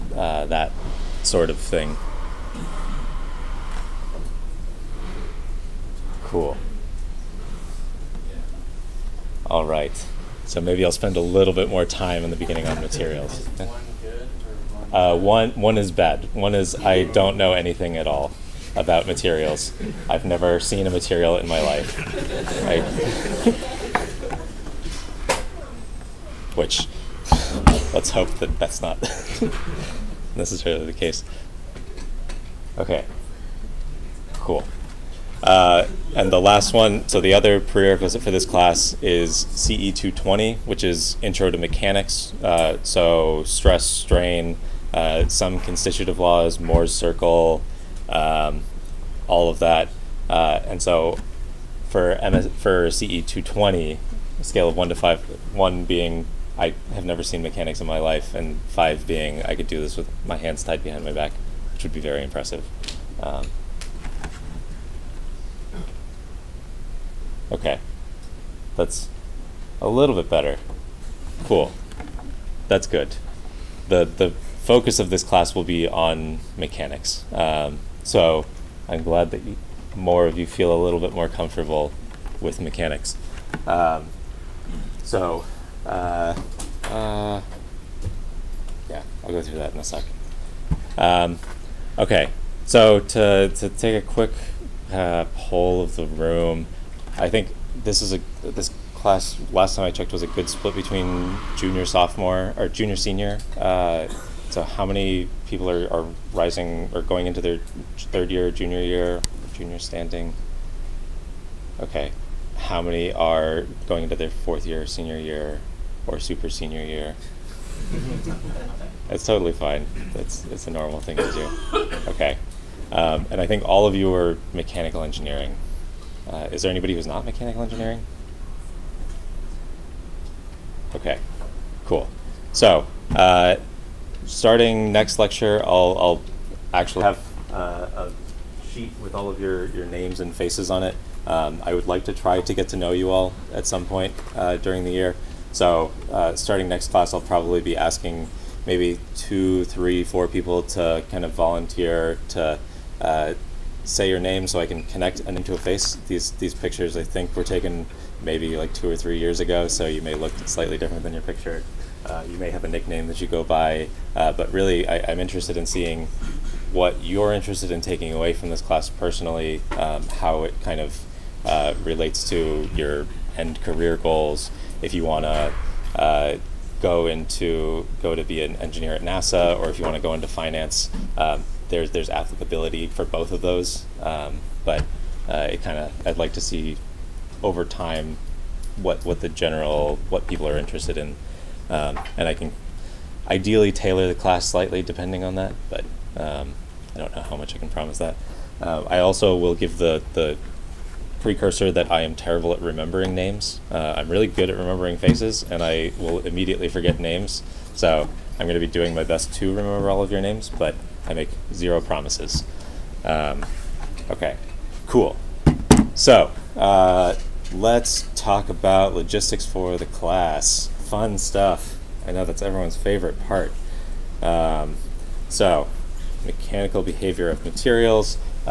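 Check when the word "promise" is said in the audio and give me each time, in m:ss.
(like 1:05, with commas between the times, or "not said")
3:17, 3:31.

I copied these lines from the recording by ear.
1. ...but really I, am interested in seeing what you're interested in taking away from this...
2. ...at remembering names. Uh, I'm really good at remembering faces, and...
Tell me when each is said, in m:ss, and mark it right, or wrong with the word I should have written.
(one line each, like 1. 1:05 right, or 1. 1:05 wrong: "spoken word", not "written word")
1. 2:44 right
2. 3:22 right.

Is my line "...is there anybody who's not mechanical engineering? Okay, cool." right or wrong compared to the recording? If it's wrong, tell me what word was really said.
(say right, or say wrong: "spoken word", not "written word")
right.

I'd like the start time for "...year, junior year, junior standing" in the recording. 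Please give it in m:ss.
1:48.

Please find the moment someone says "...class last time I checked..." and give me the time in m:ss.
1:38.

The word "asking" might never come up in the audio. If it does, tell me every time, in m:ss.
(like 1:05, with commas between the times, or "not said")
2:27.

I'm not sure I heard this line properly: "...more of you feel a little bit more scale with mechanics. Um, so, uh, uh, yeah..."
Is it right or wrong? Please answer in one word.
wrong.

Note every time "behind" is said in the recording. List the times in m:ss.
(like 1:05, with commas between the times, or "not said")
1:00.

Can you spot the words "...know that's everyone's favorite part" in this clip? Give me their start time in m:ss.
3:42.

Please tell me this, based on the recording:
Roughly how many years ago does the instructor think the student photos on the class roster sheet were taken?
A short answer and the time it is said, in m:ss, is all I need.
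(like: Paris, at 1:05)
2 or 3 years, at 2:38.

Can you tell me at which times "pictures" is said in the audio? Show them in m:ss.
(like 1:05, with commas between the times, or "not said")
2:36, 2:41.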